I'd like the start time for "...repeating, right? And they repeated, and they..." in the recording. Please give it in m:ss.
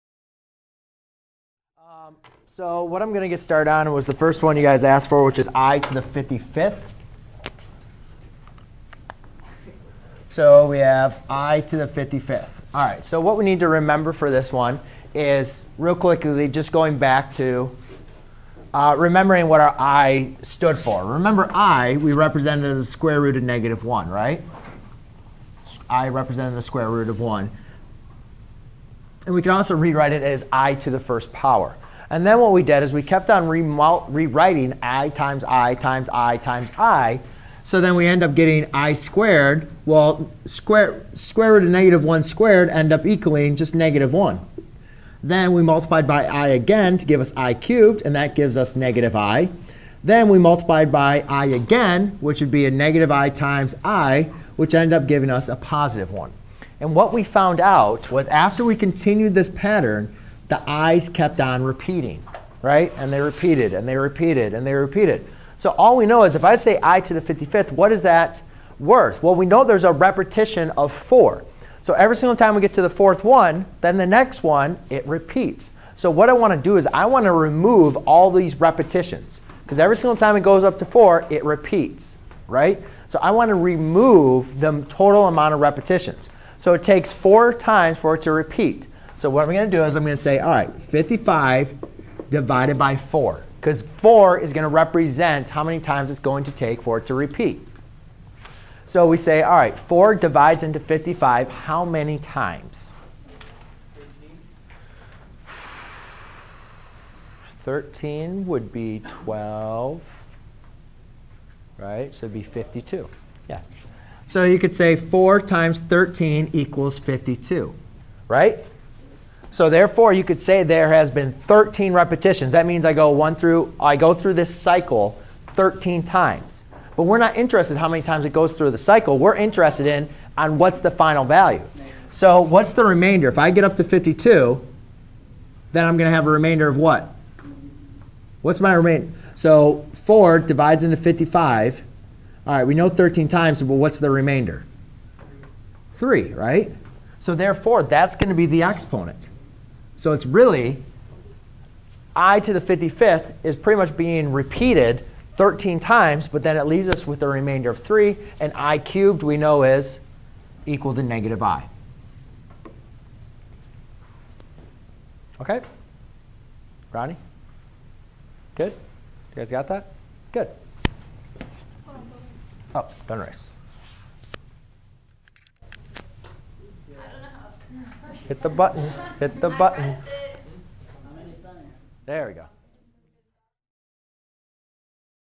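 1:01.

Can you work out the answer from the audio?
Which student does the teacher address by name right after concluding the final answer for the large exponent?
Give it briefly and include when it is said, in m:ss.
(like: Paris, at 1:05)
Ronnie, at 2:46.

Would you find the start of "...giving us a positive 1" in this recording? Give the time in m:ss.
0:55.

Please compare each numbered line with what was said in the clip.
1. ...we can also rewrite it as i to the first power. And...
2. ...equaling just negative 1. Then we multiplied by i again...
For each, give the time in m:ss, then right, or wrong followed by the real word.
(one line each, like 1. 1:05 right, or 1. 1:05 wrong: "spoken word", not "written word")
1. 0:29 right
2. 0:43 right.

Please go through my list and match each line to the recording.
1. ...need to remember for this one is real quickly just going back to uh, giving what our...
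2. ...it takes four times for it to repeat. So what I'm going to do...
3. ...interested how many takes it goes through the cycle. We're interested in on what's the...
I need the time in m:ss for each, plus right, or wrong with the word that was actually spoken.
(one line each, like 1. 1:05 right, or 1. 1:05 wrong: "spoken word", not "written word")
1. 0:13 wrong: "remembering", not "giving"
2. 1:26 right
3. 2:07 wrong: "times", not "takes".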